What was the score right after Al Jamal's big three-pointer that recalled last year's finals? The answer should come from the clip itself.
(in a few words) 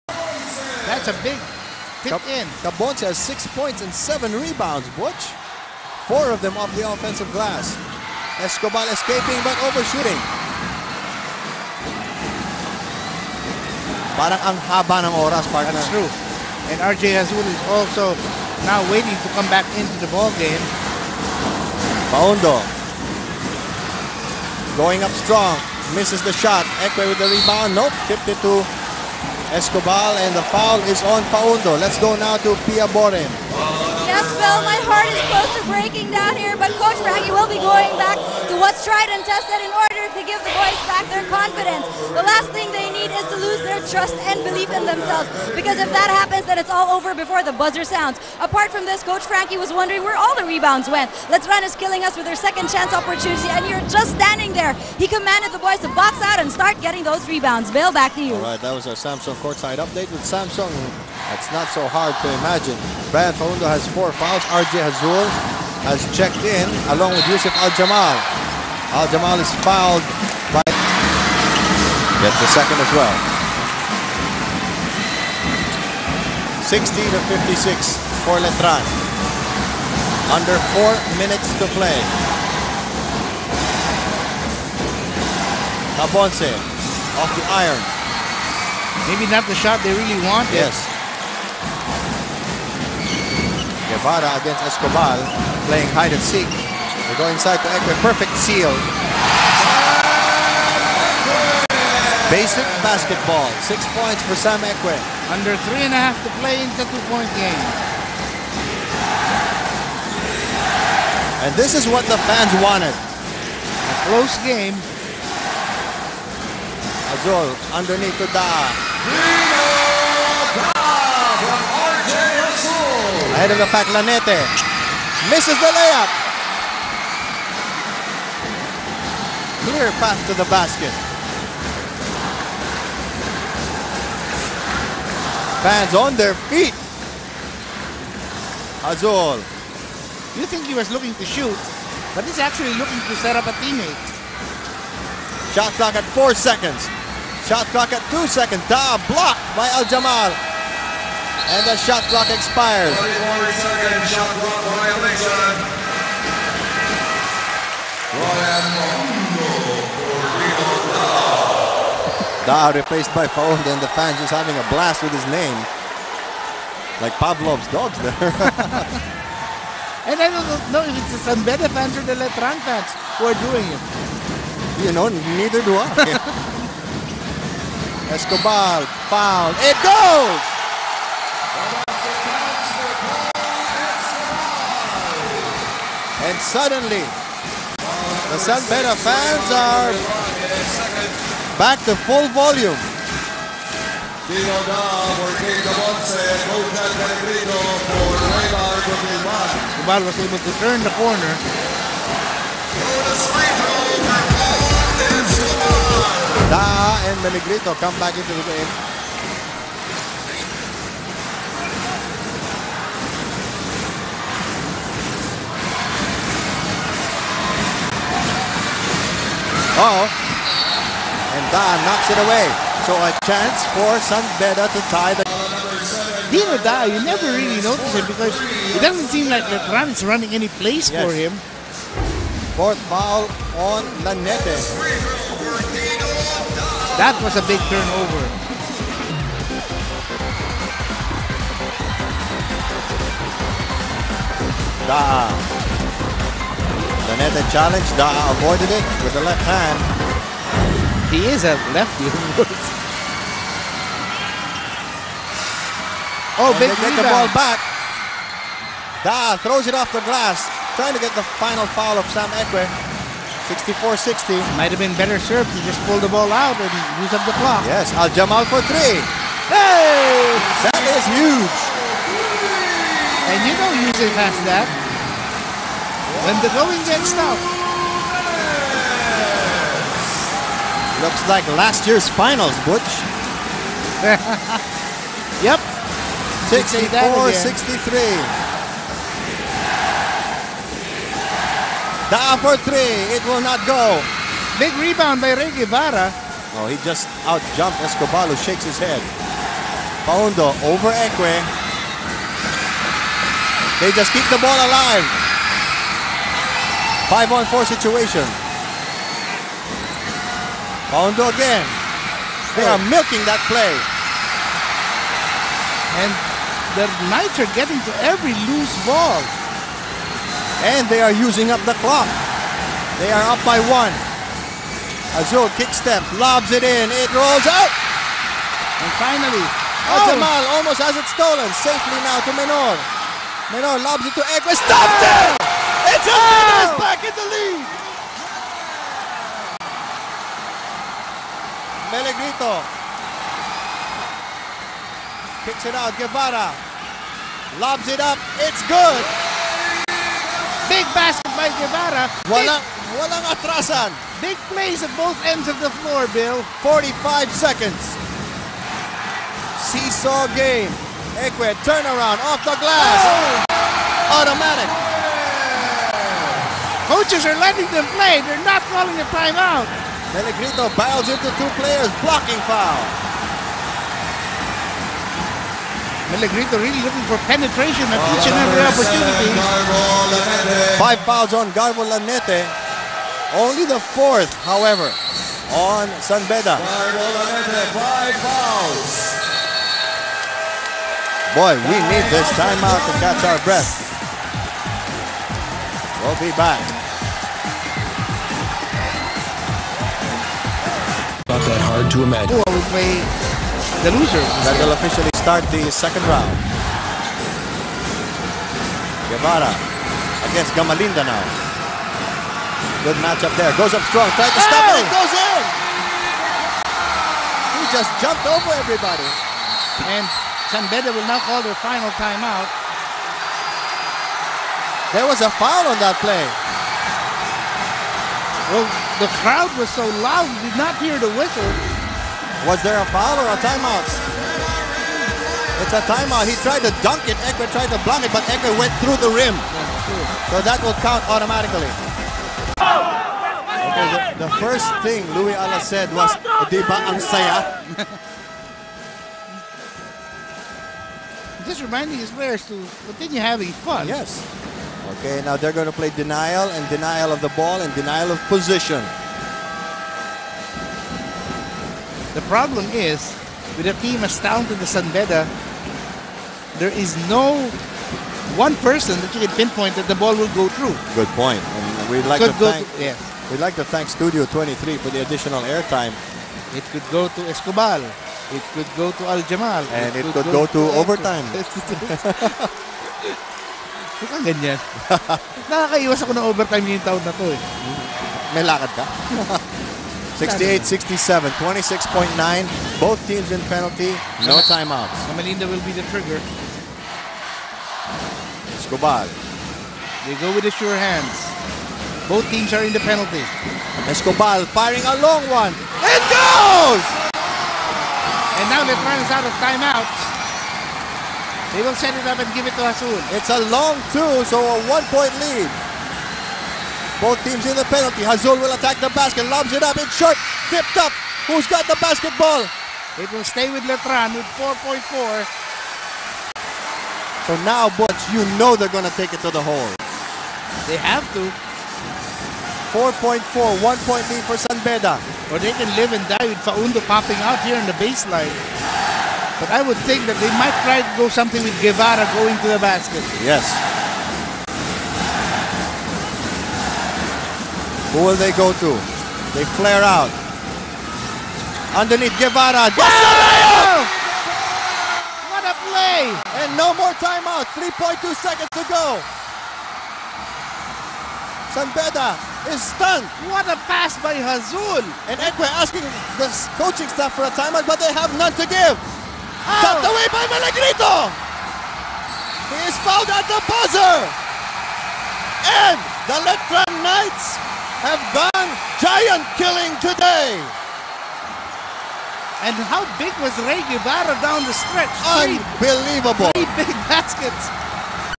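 64-63.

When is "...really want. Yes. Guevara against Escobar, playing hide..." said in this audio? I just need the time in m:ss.
1:29.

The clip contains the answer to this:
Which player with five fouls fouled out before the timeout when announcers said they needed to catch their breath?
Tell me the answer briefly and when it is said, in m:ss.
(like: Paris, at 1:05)
Garvo Lanete, at 6:21.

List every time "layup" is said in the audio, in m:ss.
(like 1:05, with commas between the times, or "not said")
2:05.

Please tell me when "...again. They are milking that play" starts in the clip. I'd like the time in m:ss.
5:11.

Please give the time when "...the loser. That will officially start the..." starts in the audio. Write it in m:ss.
6:43.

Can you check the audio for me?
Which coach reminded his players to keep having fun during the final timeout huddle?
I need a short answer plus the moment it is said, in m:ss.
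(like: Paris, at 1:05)
Louie Alas, at 7:25.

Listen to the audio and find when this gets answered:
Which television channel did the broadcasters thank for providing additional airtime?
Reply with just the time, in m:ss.
7:53.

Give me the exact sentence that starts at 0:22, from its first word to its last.
Faundo going up strong, misses the shot.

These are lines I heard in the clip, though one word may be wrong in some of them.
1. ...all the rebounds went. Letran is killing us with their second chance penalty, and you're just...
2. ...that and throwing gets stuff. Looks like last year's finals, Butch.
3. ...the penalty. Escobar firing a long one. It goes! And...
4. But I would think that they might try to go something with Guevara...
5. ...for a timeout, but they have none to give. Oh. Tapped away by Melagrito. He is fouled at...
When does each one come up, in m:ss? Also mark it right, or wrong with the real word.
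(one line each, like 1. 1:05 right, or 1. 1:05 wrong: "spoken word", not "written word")
1. 0:50 wrong: "opportunity", not "penalty"
2. 4:34 right
3. 8:22 right
4. 8:59 right
5. 9:27 right.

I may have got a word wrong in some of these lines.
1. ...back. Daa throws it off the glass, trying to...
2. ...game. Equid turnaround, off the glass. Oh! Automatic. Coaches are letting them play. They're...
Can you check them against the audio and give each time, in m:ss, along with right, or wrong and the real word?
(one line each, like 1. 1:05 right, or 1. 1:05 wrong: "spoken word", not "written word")
1. 4:17 right
2. 6:00 right.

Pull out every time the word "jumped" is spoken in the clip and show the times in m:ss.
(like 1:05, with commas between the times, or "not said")
4:57, 6:57.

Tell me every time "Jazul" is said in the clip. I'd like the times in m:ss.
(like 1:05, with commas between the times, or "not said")
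0:17, 1:04, 1:57, 2:18, 5:25, 8:32, 8:38, 9:24.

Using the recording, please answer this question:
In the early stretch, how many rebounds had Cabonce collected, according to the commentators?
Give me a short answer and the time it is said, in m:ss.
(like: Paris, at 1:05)
7, at 0:03.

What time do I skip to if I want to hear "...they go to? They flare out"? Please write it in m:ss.
9:08.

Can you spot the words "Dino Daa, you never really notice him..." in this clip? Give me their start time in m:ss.
3:46.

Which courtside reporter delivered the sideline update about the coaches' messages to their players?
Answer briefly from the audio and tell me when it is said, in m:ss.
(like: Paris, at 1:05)
Pia Boren, at 0:32.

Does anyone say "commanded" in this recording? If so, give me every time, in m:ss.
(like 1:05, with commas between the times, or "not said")
0:55.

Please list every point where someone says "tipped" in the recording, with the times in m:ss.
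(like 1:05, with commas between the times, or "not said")
0:28, 8:40.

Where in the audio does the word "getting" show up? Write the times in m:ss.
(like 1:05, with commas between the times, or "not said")
0:56, 5:17.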